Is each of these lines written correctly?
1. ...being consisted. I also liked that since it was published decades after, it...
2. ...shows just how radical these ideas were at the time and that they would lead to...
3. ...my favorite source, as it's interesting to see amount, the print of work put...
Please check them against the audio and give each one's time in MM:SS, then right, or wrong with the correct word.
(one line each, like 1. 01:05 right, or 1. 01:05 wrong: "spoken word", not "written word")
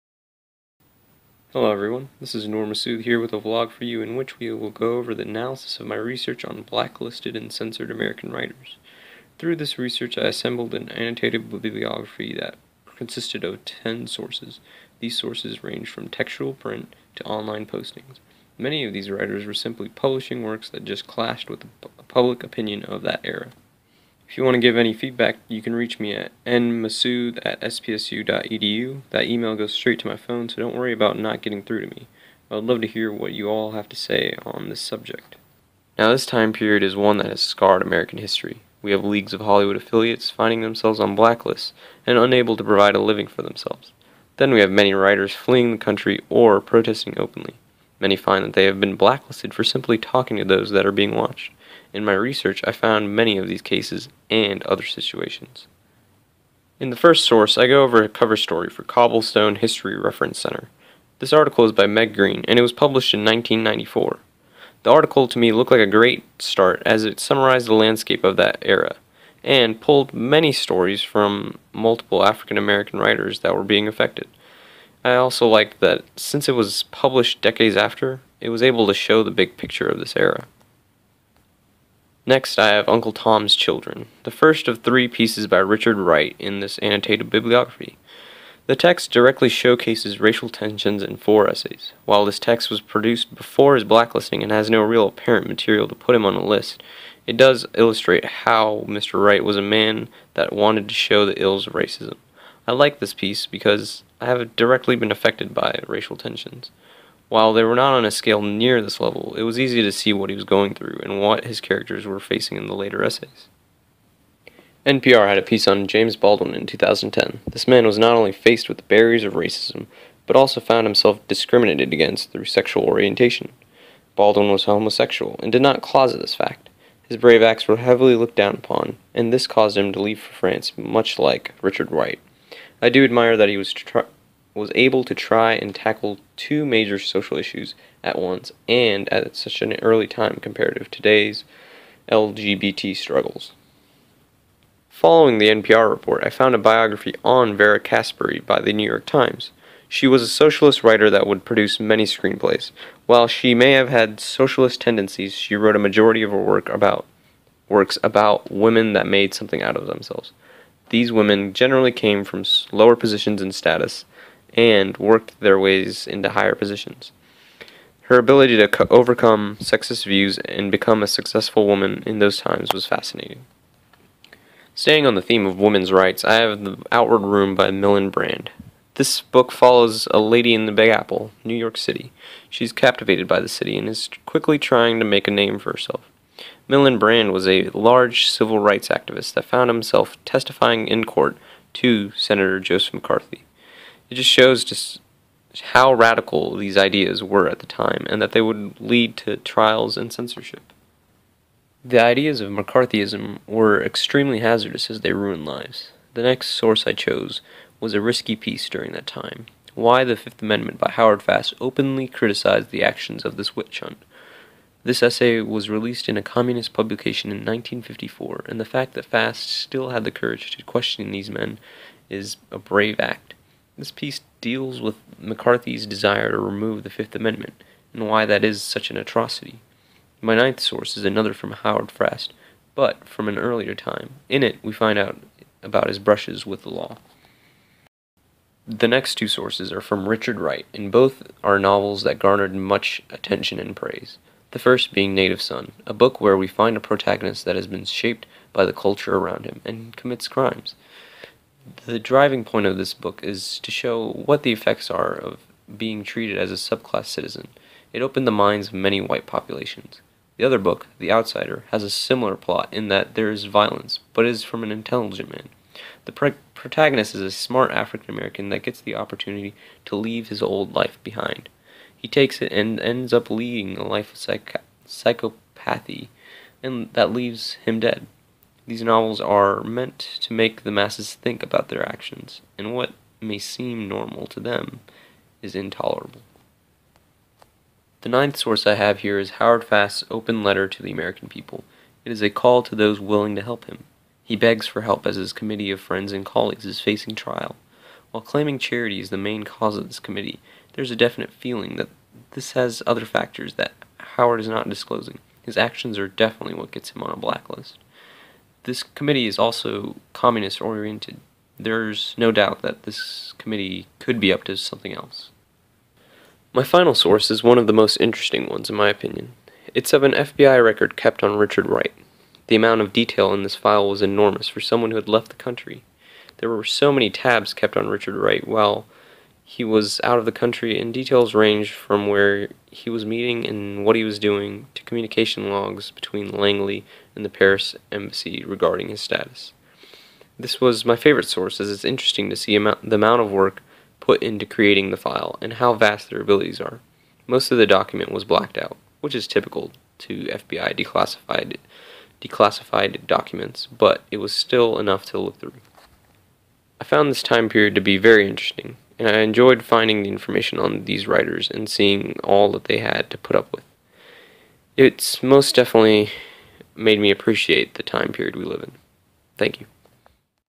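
1. 01:13 wrong: "affected", not "consisted"
2. 03:14 right
3. 05:40 wrong: "amount", not "print".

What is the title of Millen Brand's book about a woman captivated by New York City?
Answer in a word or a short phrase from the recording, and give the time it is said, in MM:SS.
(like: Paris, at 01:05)
The Outward Room, at 02:56.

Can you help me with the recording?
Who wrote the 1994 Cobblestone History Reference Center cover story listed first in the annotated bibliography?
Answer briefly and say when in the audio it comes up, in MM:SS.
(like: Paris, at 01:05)
Meg Green, at 01:01.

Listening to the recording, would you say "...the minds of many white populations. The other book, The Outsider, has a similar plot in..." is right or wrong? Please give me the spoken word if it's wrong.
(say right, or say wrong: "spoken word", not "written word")
right.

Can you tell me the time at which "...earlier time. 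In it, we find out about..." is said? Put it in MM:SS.
03:53.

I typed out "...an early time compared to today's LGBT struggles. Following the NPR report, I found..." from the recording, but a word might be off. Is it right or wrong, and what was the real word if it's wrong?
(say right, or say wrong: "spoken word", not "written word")
right.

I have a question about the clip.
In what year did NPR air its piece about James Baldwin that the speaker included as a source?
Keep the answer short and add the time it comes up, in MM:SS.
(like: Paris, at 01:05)
2010, at 01:56.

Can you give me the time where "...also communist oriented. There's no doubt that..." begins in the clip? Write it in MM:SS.
05:09.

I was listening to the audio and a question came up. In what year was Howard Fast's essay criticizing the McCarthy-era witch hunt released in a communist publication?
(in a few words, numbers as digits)
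1954.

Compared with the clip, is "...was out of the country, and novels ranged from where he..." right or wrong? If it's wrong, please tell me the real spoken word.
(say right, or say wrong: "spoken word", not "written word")
wrong: "details", not "novels".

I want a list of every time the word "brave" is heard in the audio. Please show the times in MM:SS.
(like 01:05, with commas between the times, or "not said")
02:07, 03:42.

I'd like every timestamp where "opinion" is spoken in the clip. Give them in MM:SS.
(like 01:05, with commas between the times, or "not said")
00:22, 05:18.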